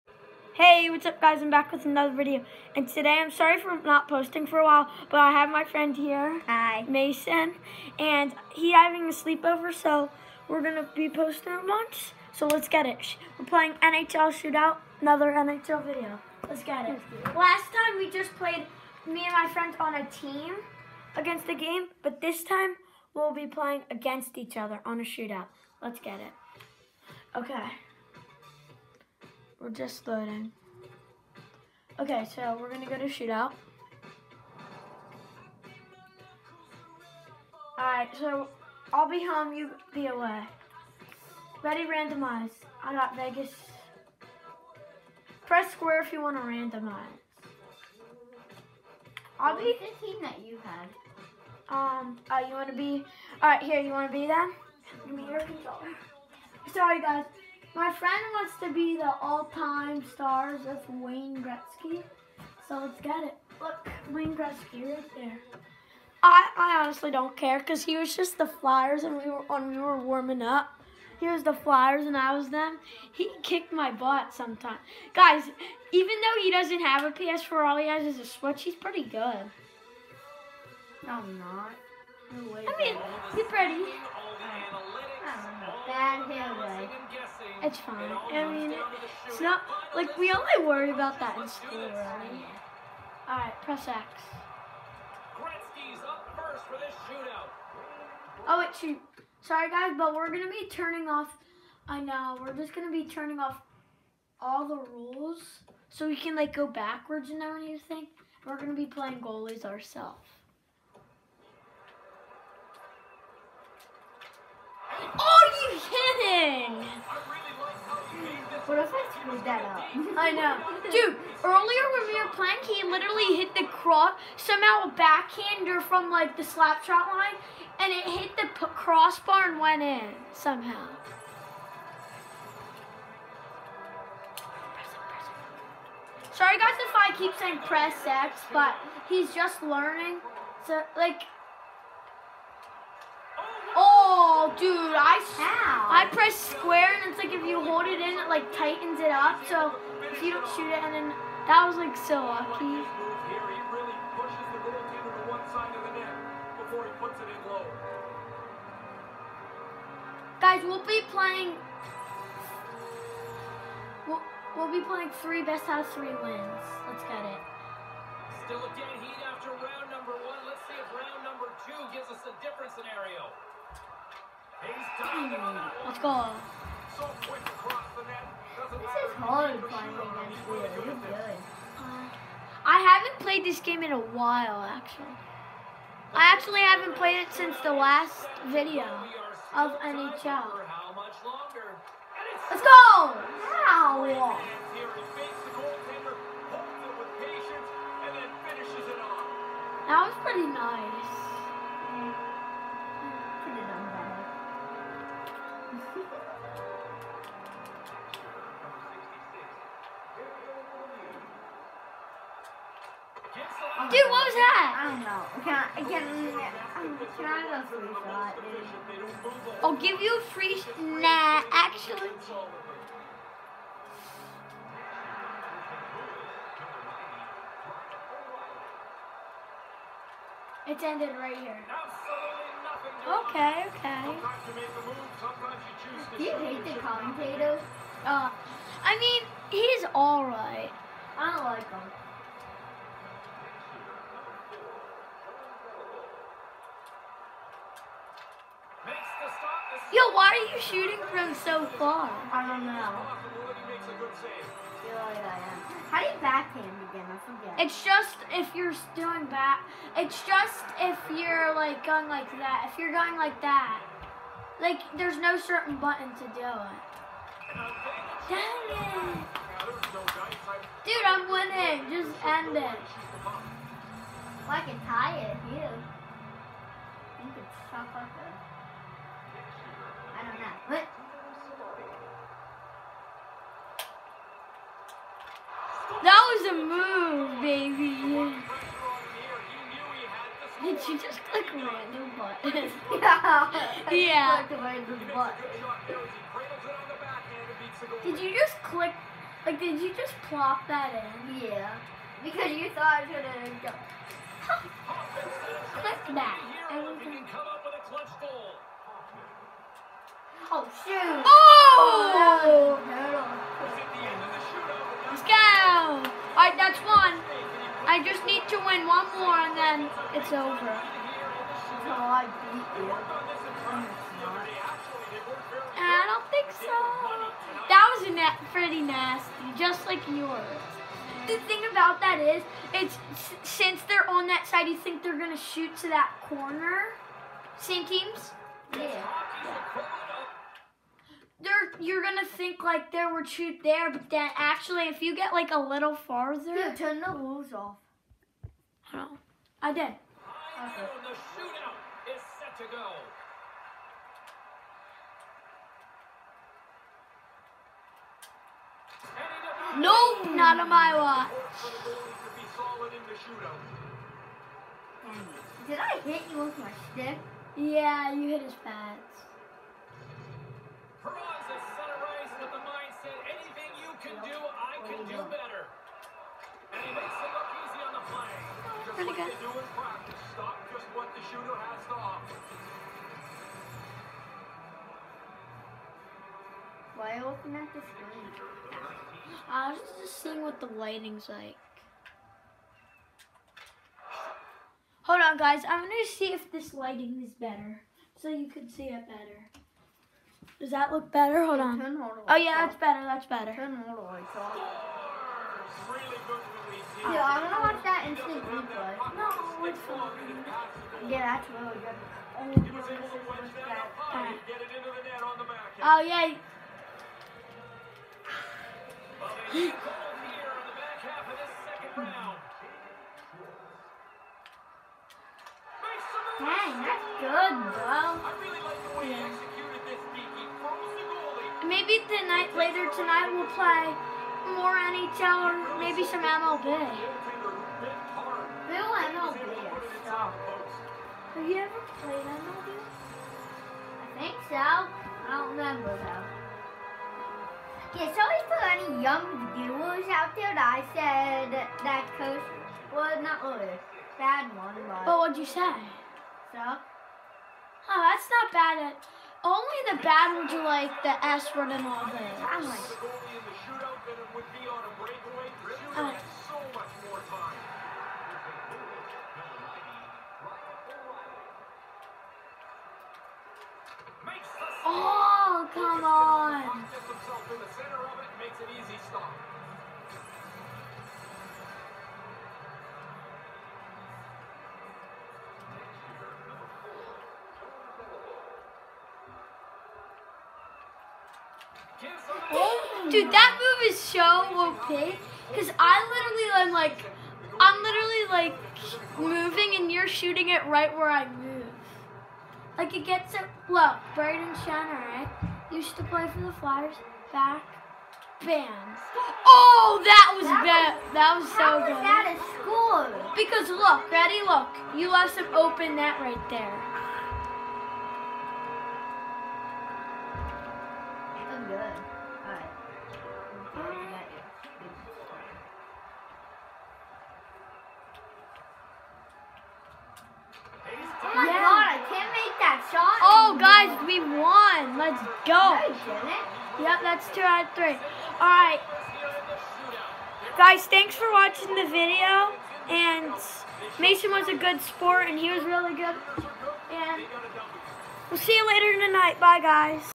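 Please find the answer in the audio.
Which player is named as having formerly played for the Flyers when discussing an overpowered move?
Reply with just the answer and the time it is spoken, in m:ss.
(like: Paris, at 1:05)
Brayden Schenn, at 8:24.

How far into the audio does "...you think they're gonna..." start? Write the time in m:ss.
5:34.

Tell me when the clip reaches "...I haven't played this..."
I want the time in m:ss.
3:02.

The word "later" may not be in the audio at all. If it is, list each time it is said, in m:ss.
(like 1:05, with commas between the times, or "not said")
7:12, 9:08.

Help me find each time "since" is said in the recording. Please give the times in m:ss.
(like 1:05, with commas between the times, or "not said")
3:07, 5:33.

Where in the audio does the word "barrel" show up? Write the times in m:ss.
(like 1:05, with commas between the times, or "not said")
not said.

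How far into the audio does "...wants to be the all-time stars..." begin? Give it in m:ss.
0:58.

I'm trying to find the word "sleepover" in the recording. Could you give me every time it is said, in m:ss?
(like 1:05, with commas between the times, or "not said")
0:09.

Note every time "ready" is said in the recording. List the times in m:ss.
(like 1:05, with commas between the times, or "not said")
0:41, 8:34.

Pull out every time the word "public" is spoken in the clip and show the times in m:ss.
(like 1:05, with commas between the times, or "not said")
not said.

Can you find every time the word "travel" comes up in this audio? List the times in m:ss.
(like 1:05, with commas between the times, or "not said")
not said.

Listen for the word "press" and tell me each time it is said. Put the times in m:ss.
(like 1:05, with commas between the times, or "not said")
0:45, 1:33, 2:17, 2:26.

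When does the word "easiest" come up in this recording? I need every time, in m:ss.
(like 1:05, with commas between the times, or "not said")
not said.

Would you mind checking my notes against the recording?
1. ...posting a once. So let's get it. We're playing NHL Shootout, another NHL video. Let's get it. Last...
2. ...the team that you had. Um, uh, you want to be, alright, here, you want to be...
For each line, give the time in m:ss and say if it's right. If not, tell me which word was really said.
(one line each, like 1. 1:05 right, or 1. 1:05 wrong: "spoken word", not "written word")
1. 0:11 right
2. 0:49 right.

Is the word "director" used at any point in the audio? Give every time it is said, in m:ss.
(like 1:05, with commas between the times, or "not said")
not said.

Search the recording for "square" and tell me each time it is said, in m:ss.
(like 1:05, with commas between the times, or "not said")
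0:45, 2:26.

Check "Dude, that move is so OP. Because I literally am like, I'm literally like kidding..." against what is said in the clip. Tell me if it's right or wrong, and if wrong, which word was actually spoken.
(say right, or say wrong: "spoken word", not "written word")
wrong: "moving", not "kidding".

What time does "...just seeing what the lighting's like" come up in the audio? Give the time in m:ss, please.
6:29.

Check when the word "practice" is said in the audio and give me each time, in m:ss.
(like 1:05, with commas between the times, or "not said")
6:19.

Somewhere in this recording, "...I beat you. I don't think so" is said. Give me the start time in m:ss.
5:21.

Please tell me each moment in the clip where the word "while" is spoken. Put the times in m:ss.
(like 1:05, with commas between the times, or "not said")
0:04, 3:03.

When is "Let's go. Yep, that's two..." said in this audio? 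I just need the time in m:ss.
8:54.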